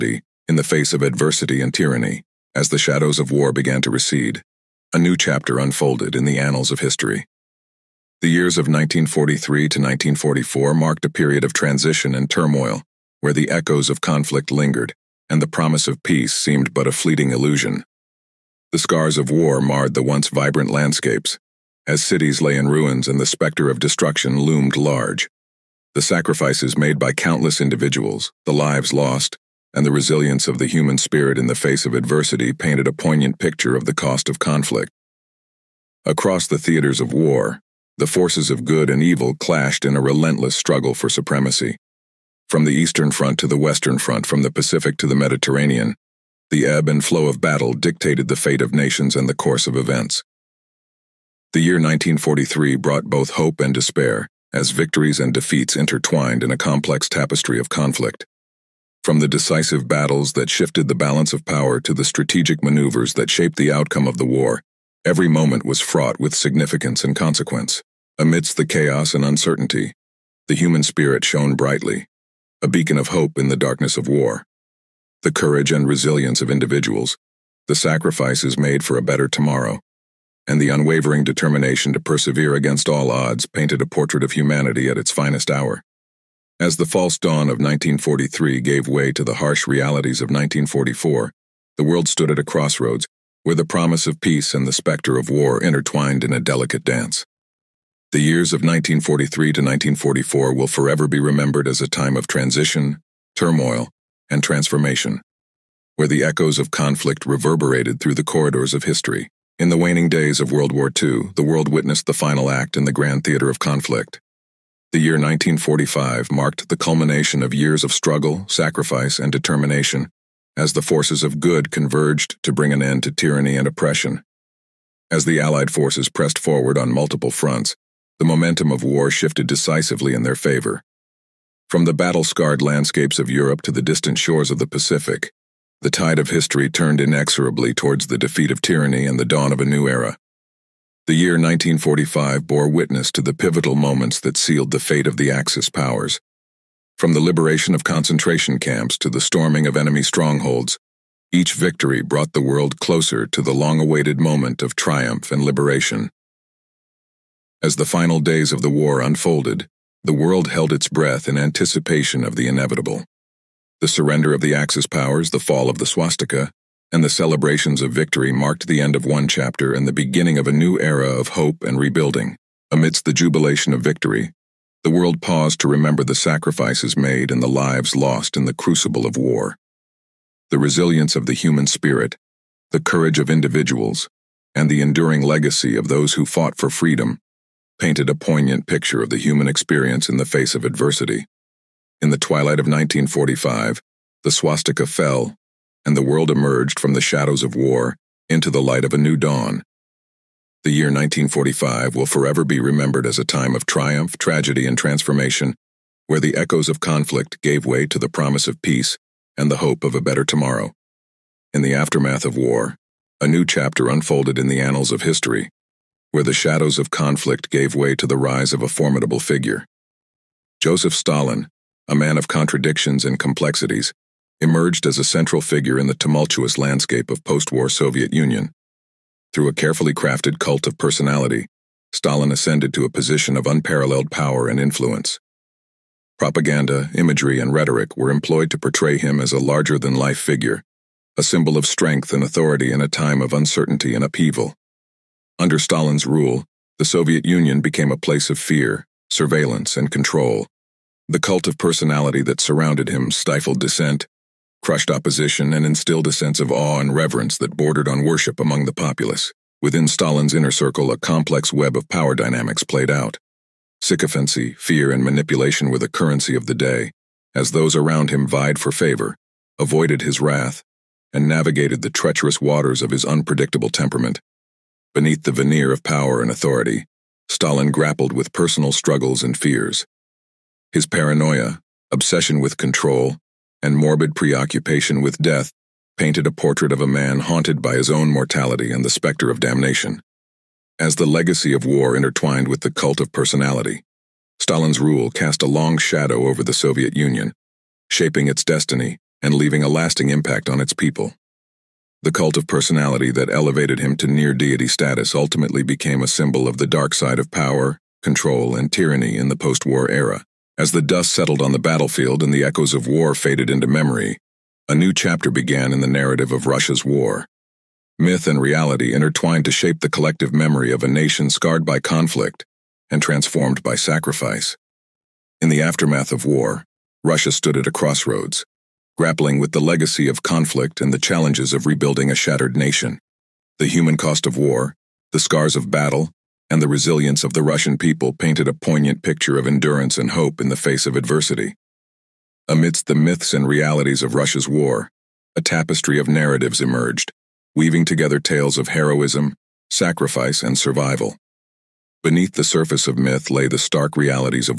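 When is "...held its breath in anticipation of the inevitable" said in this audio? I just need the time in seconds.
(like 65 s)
160 s.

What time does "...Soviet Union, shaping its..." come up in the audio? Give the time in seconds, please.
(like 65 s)
296 s.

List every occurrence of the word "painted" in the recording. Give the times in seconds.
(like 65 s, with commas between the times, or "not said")
32 s, 83 s, 187 s, 285 s, 338 s.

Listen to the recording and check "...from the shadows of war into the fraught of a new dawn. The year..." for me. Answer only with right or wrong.
wrong.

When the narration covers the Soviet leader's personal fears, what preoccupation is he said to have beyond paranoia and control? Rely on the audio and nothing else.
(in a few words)
morbid preoccupation with death.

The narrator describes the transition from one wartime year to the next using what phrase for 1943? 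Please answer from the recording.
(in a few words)
false dawn.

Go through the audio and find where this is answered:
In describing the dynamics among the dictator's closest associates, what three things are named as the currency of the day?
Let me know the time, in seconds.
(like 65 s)
263 s.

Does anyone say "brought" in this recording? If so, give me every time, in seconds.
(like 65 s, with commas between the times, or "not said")
52 s, 152 s.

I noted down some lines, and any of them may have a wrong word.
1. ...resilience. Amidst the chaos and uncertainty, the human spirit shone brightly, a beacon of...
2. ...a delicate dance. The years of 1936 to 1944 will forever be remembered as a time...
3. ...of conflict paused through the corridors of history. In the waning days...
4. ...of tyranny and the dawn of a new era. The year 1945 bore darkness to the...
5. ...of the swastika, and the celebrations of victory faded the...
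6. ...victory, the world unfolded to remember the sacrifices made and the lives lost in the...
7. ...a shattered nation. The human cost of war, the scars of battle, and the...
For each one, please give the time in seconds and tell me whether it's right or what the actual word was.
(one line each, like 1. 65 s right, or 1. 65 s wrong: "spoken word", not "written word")
1. 67 s wrong: "consequence", not "resilience"
2. 96 s wrong: "1943", not "1936"
3. 106 s wrong: "reverberated", not "paused"
4. 138 s wrong: "witness", not "darkness"
5. 165 s wrong: "marked", not "faded"
6. 173 s wrong: "paused", not "unfolded"
7. 332 s right.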